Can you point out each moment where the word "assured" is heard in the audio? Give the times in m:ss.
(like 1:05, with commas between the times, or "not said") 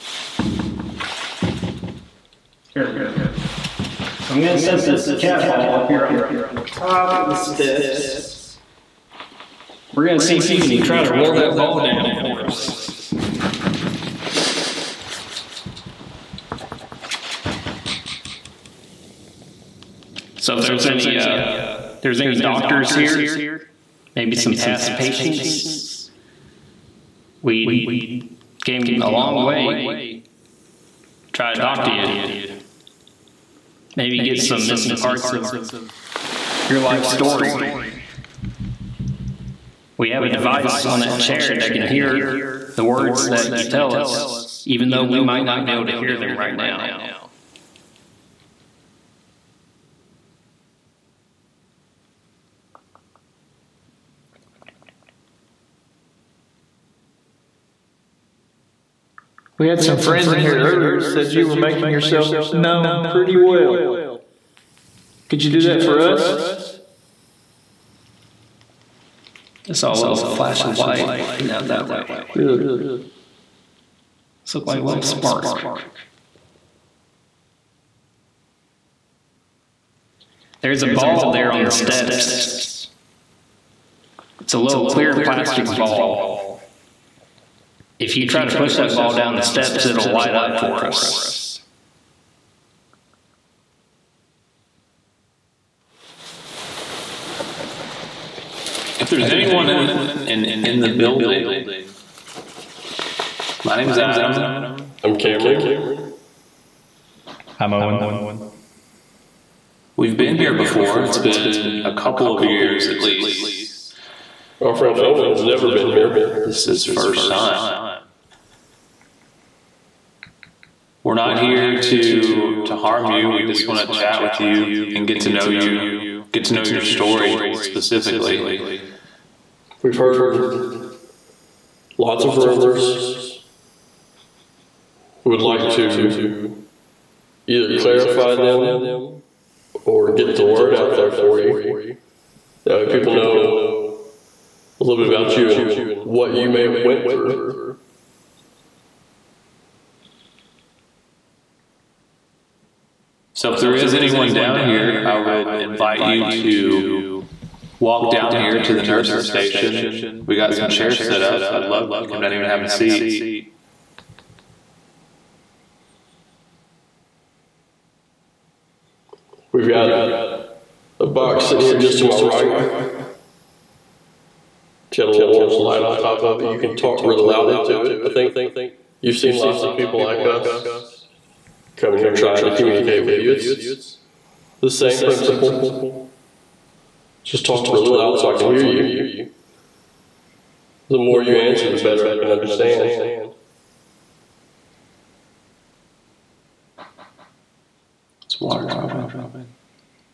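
not said.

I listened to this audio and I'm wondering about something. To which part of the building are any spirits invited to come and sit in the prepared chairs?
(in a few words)
nurse's station.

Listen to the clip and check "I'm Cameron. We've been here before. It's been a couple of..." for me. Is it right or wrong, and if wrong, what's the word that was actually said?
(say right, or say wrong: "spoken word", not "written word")
wrong: "Owen", not "Cameron".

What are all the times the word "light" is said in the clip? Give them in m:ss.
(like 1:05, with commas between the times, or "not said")
1:10, 1:30, 2:55.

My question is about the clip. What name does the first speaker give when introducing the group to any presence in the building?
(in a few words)
Adam.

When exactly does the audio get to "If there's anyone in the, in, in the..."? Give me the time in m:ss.
1:38.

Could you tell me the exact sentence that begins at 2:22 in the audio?
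That way people know a little bit about you and what you may have went through.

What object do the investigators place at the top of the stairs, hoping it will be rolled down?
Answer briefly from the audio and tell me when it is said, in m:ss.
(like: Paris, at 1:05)
cat ball, at 0:05.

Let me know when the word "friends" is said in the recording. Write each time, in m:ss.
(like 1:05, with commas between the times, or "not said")
0:59, 1:54.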